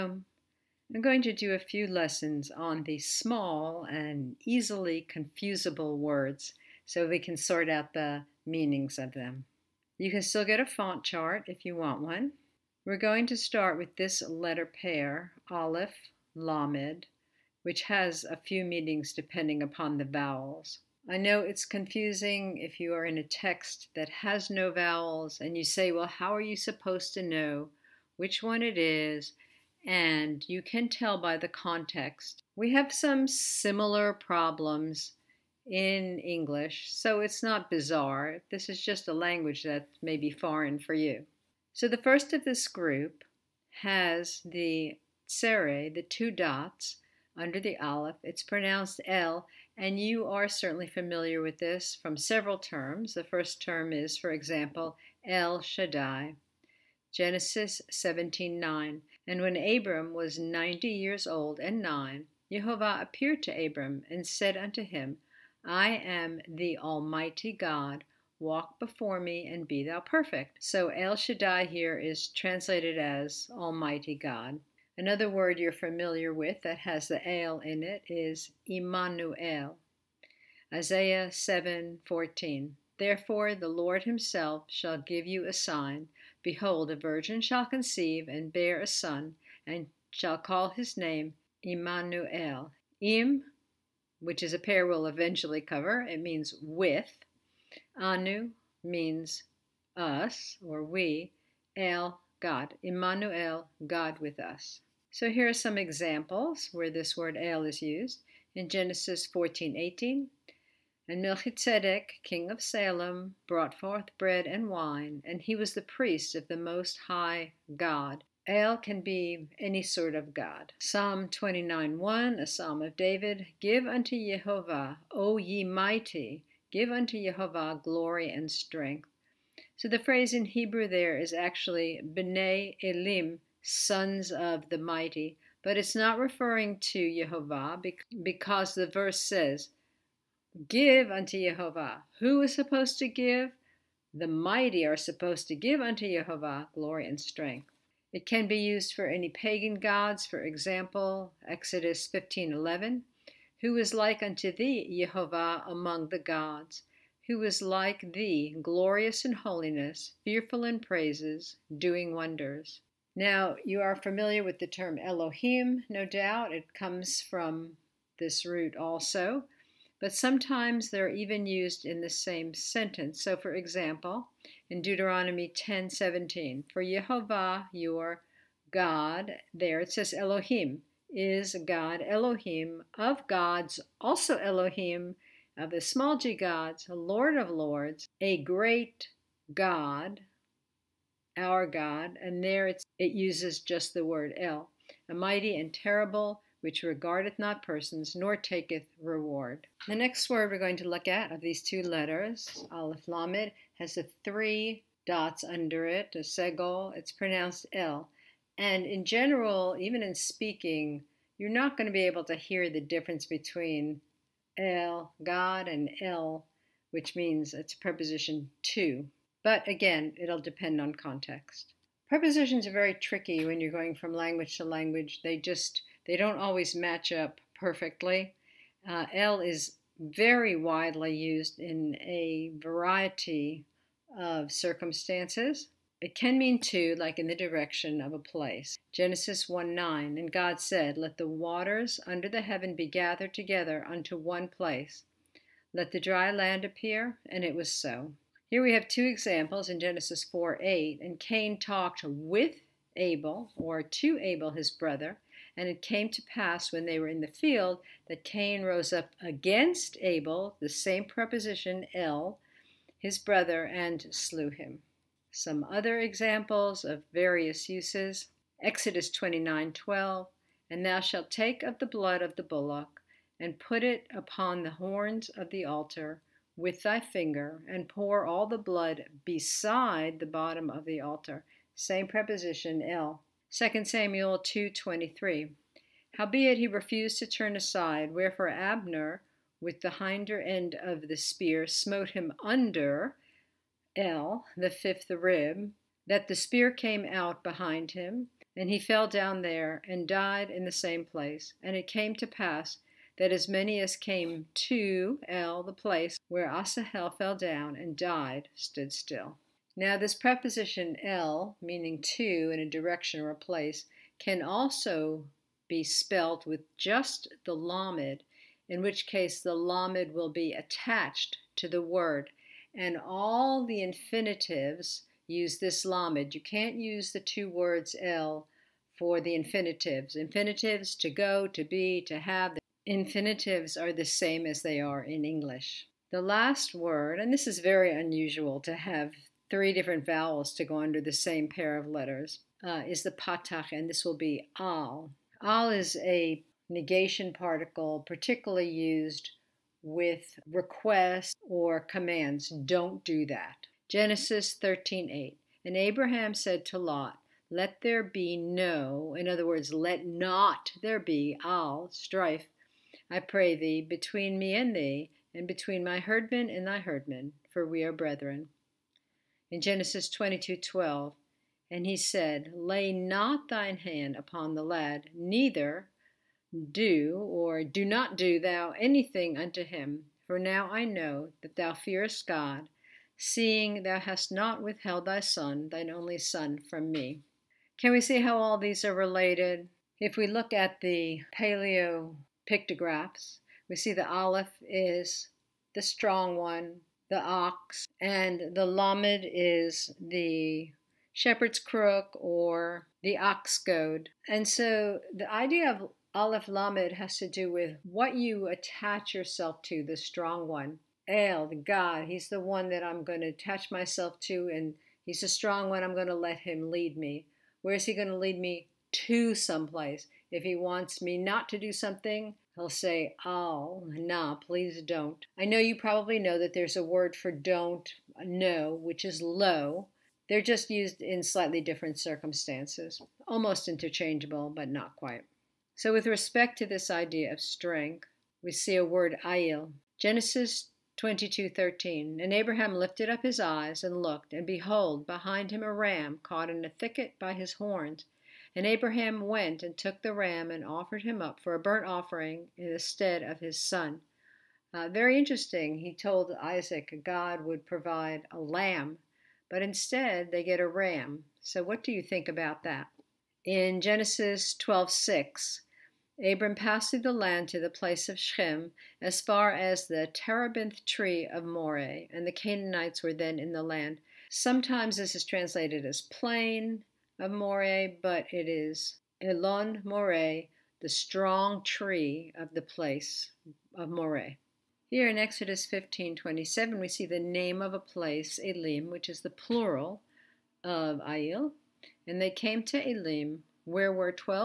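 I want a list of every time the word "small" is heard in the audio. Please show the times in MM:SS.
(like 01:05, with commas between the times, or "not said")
00:02, 03:05.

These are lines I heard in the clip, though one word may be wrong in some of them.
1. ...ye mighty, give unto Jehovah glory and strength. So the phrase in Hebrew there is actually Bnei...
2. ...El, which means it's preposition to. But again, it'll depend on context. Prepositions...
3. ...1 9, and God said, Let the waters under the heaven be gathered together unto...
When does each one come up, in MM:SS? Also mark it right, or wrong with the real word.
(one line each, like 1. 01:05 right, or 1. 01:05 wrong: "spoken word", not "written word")
1. 02:05 right
2. 03:36 right
3. 03:59 right.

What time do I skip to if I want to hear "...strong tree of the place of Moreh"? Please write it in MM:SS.
08:00.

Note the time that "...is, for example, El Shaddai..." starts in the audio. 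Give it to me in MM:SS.
00:53.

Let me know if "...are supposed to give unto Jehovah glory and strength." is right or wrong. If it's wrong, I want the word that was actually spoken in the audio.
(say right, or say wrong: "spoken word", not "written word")
right.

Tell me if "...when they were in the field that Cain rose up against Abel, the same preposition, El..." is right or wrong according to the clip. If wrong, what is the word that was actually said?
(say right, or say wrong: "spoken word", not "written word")
right.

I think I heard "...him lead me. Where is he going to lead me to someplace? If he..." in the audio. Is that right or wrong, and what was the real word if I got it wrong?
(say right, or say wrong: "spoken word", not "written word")
right.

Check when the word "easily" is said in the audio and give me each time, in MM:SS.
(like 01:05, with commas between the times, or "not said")
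00:04.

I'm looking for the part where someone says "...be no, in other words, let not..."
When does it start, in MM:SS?
05:58.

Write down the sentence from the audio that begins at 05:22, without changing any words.
And all the infinitives use this lamed.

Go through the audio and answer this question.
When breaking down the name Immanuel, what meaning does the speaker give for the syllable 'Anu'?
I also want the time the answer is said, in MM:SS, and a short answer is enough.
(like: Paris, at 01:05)
us or we, at 01:39.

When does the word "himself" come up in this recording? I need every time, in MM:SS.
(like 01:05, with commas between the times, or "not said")
01:24.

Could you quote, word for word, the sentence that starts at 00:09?
You can still get a font chart if you want one.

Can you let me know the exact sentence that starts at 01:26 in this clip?
Behold, a virgin shall conceive and bear a son, and shall call his name Immanuel.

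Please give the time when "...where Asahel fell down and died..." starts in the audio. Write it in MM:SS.
05:06.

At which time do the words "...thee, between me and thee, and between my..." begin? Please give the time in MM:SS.
06:03.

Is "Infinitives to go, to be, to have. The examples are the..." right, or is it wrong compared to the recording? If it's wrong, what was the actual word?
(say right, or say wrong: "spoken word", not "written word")
wrong: "infinitives", not "examples".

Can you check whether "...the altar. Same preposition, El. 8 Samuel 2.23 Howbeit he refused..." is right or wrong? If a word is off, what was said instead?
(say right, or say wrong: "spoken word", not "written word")
wrong: "2", not "8".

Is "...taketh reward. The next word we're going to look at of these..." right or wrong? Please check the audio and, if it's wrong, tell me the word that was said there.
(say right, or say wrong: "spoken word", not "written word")
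right.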